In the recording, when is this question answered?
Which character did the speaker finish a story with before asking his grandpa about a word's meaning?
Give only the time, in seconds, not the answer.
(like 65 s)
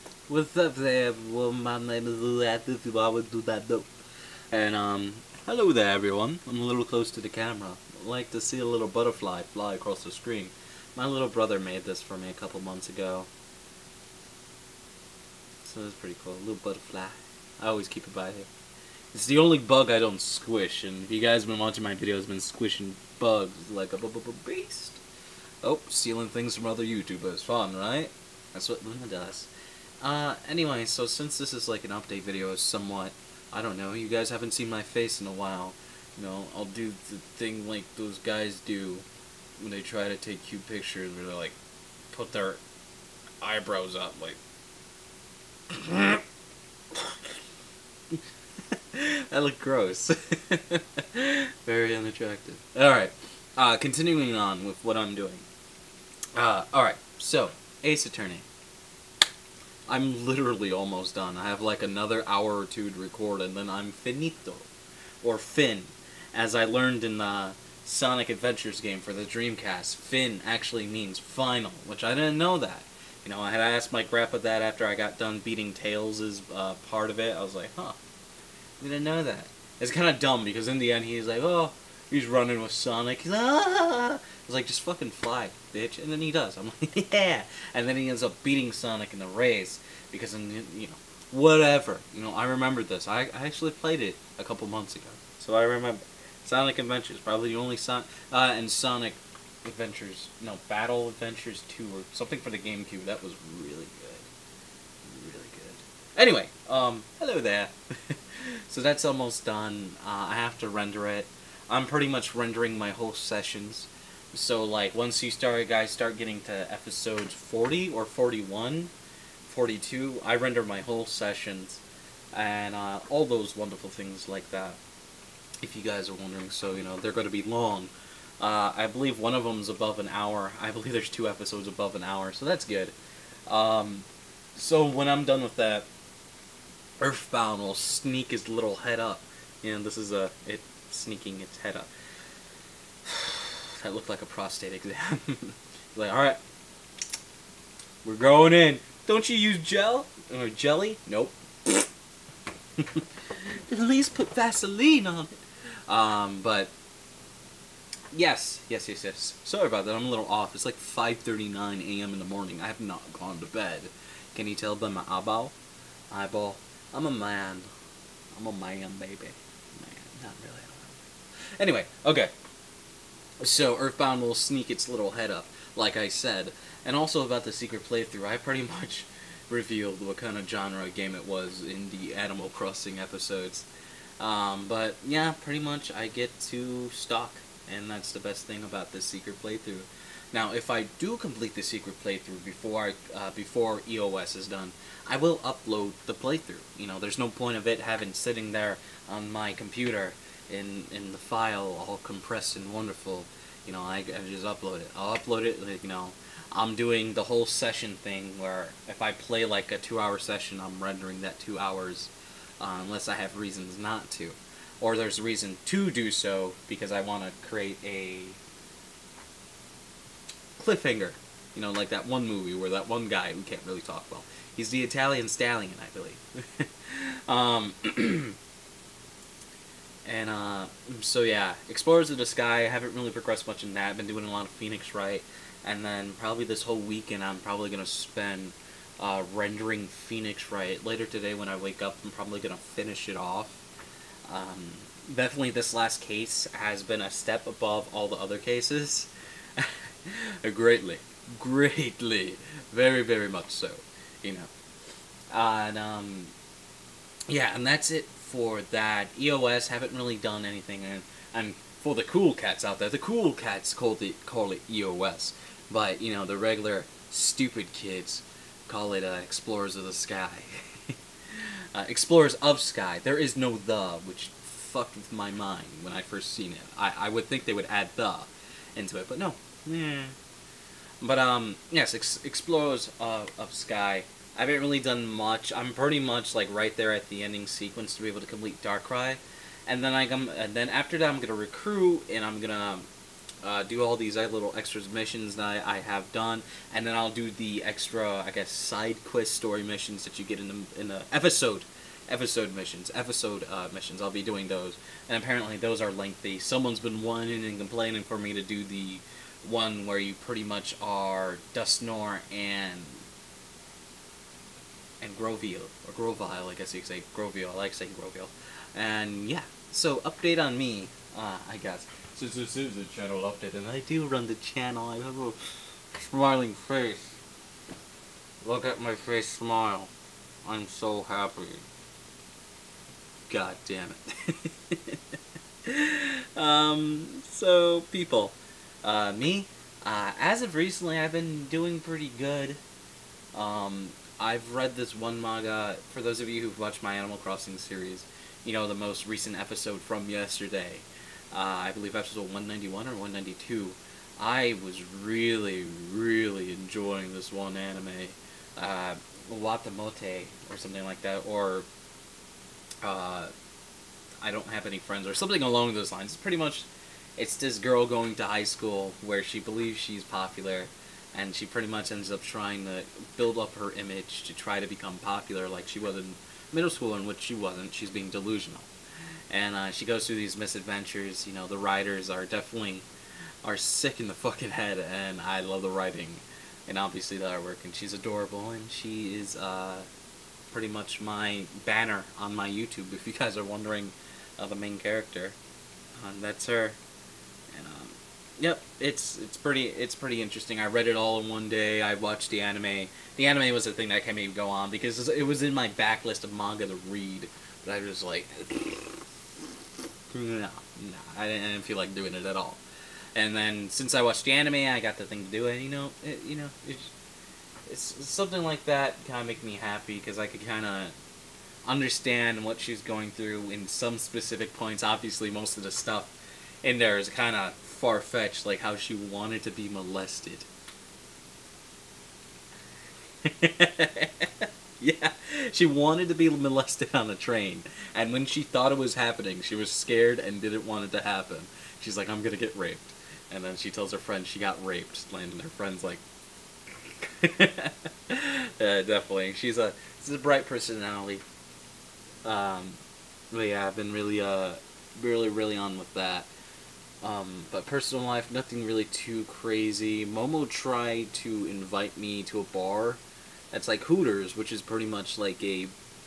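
75 s.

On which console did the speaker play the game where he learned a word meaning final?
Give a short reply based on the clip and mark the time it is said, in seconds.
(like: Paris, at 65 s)
Dreamcast, at 69 s.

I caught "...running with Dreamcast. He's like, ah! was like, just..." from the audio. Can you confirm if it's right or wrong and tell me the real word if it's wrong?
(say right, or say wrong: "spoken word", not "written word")
wrong: "Sonic", not "Dreamcast".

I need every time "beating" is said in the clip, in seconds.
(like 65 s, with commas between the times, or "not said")
75 s, 88 s.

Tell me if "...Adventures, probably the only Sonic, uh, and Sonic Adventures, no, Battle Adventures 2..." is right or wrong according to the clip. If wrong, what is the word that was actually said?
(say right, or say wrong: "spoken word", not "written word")
right.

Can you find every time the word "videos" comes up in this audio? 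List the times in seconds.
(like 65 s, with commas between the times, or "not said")
21 s, 32 s.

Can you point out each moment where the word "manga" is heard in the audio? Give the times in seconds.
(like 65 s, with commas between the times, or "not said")
345 s, 406 s.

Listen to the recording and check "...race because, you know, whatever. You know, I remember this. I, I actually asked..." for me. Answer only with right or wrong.
wrong.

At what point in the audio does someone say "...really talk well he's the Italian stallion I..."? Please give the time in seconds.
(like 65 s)
223 s.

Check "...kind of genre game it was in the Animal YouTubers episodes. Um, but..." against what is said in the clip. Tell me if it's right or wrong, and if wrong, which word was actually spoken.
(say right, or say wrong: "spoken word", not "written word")
wrong: "Crossing", not "YouTubers".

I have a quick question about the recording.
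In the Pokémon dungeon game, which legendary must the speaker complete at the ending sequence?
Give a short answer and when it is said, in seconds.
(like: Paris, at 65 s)
Darkrai, at 288 s.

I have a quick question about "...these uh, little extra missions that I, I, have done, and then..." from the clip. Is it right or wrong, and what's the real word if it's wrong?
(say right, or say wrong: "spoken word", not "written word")
right.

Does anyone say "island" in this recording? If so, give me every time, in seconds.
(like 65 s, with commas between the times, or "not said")
not said.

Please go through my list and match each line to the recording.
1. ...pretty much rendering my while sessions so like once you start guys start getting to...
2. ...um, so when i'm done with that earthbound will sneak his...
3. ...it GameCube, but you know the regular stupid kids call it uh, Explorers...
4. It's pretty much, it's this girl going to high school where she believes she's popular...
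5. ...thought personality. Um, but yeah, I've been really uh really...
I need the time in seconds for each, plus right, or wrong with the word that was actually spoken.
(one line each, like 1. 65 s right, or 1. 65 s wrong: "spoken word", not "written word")
1. 111 s wrong: "whole", not "while"
2. 133 s right
3. 264 s wrong: "EOS", not "GameCube"
4. 366 s right
5. 450 s wrong: "bright", not "thought".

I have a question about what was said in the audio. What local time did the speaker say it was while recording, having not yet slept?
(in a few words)
5:39 a.m.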